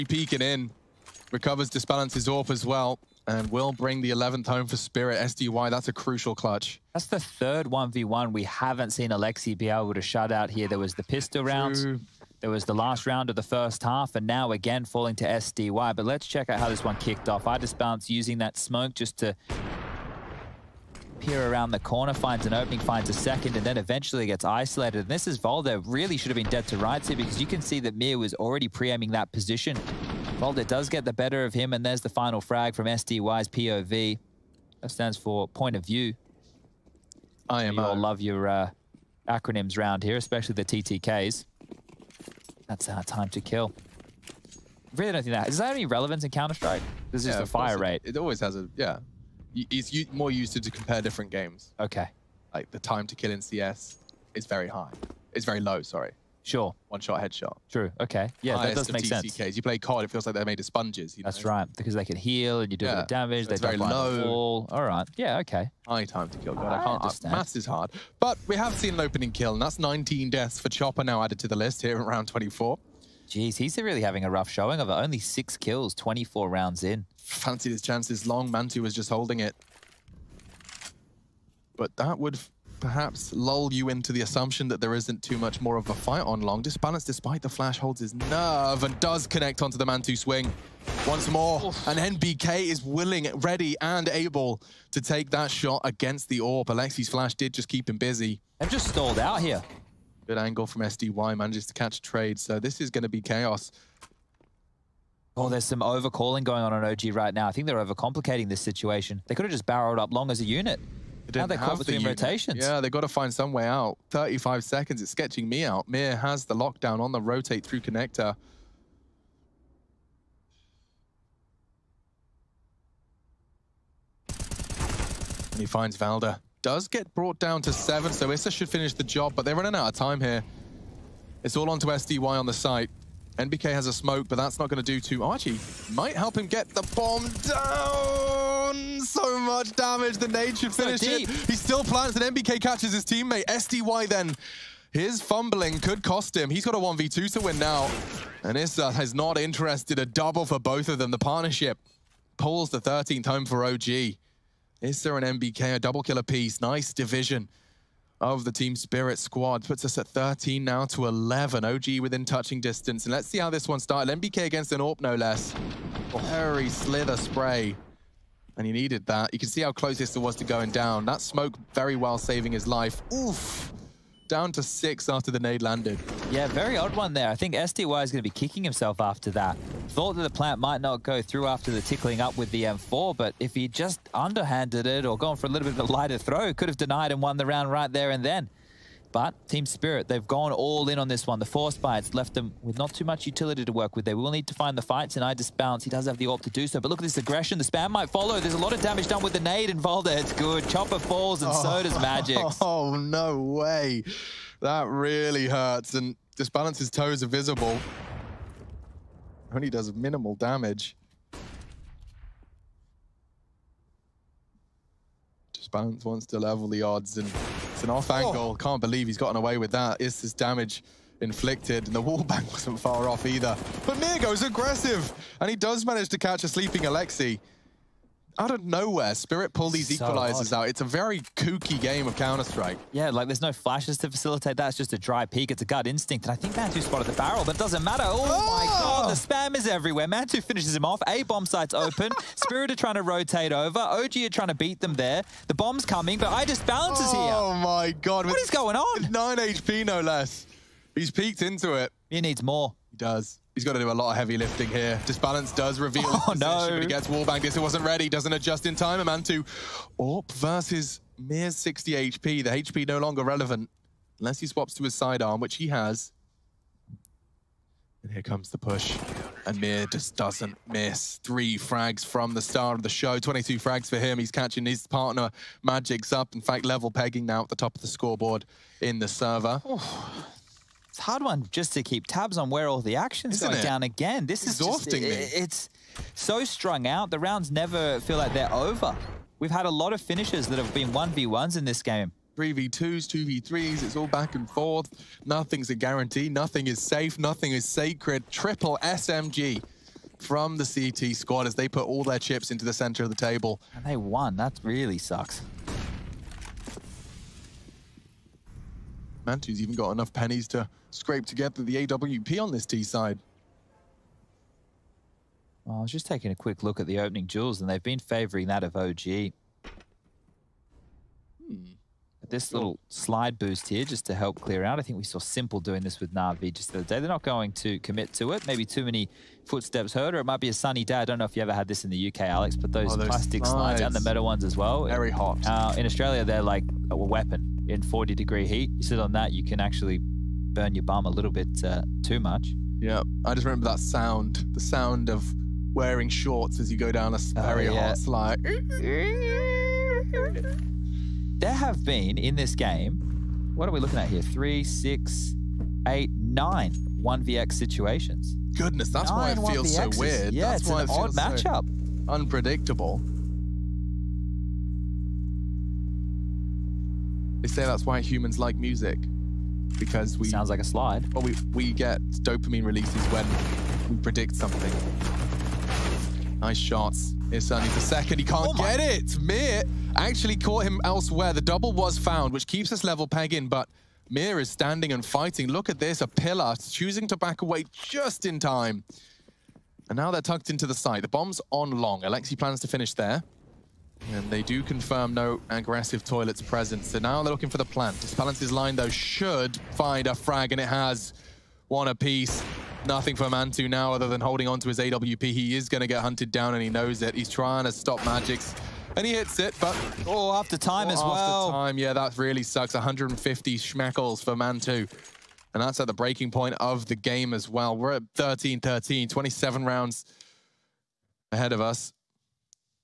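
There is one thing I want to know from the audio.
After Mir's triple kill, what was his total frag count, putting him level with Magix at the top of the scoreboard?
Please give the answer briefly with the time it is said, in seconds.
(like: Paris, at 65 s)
22, at 273 s.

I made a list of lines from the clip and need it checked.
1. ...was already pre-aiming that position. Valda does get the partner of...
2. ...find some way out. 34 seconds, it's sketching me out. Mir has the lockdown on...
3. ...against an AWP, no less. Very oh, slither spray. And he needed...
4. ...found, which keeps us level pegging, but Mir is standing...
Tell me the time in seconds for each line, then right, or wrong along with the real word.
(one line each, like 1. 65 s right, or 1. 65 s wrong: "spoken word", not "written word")
1. 28 s wrong: "better", not "partner"
2. 113 s wrong: "35", not "34"
3. 164 s right
4. 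381 s right.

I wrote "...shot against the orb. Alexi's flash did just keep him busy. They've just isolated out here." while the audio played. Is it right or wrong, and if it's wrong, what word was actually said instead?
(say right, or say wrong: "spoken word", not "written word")
wrong: "stalled", not "isolated".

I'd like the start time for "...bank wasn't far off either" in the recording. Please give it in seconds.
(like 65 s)
222 s.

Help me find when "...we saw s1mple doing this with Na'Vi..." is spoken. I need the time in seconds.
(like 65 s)
324 s.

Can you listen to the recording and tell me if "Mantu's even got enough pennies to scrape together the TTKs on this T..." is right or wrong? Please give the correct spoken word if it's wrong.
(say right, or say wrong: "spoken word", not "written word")
wrong: "AWP", not "TTKs".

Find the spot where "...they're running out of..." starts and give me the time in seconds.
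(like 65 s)
129 s.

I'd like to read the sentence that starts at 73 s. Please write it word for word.
Jeez, he's really having a rough showing of it.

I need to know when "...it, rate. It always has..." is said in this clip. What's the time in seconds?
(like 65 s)
47 s.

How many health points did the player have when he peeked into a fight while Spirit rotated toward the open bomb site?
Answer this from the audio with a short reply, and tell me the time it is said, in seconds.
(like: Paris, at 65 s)
9, at 249 s.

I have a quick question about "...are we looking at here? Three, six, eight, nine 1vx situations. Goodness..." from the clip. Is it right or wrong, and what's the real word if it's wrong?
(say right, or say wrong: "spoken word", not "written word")
right.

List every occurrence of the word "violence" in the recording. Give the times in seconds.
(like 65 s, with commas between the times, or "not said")
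not said.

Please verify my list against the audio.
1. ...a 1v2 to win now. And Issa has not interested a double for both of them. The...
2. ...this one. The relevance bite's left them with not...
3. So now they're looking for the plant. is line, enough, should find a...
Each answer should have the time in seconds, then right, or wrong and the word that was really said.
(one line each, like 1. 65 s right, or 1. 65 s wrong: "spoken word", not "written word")
1. 146 s right
2. 191 s wrong: "force", not "relevance"
3. 396 s wrong: "though", not "enough".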